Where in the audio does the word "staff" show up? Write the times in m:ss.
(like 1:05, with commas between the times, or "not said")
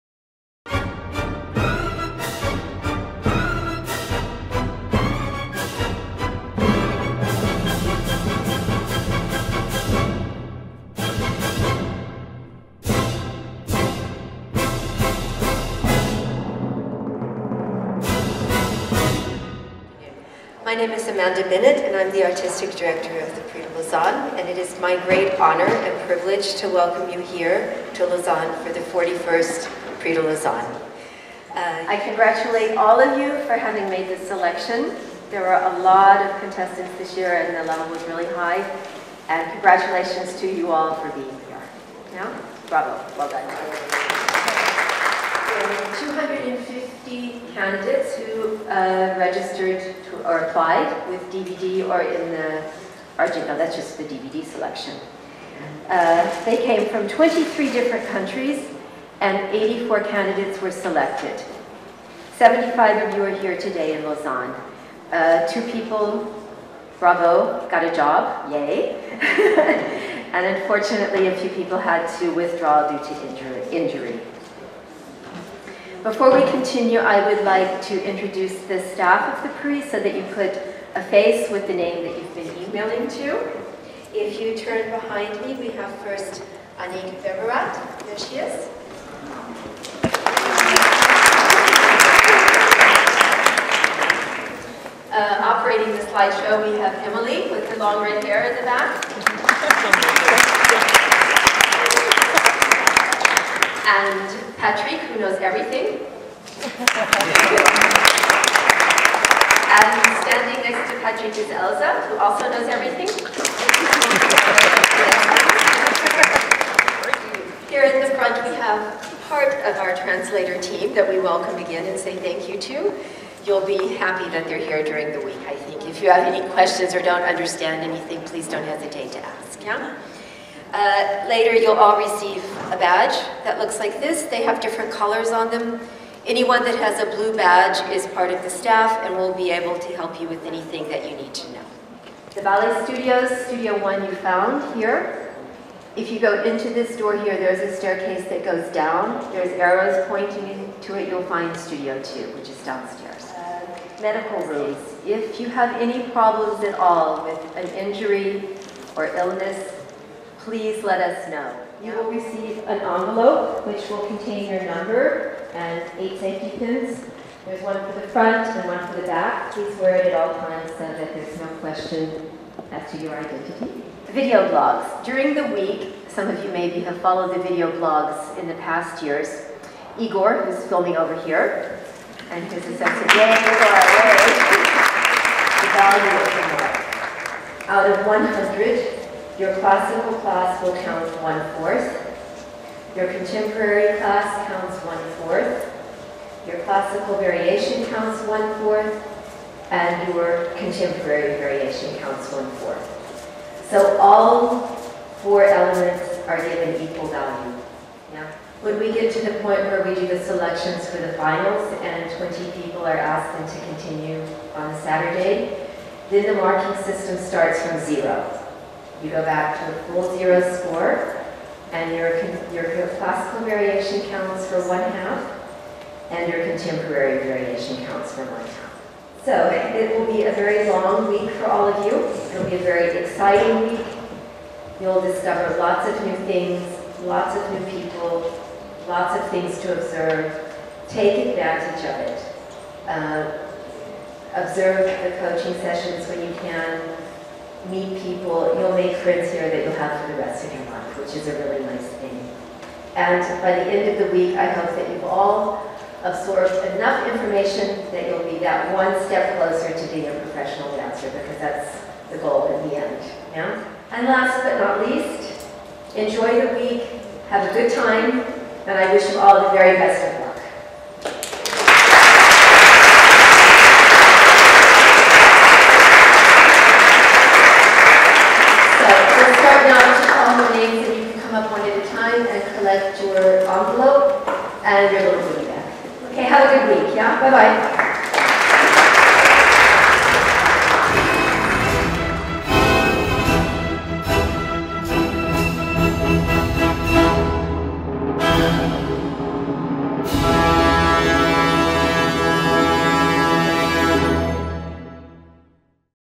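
1:18, 2:18.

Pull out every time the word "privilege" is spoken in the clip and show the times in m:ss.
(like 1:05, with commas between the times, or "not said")
0:26.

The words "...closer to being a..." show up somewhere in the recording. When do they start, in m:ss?
4:19.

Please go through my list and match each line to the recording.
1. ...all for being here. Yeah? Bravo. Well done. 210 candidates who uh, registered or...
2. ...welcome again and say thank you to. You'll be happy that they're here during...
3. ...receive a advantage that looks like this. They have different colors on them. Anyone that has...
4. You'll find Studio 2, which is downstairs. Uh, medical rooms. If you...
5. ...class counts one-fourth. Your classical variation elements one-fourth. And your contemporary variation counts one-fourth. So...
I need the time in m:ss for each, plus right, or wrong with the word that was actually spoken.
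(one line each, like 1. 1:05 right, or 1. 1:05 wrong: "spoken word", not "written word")
1. 0:40 wrong: "250", not "210"
2. 2:01 right
3. 2:11 wrong: "badge", not "advantage"
4. 2:31 right
5. 3:13 wrong: "counts", not "elements".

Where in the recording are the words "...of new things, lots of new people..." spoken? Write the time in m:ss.
3:55.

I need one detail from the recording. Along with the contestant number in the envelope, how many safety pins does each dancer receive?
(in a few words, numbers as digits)
8.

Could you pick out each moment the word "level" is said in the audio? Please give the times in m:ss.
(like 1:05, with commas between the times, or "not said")
0:37.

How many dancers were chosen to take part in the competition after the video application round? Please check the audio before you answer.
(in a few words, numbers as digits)
84.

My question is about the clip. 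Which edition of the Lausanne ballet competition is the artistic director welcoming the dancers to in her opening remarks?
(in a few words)
41st.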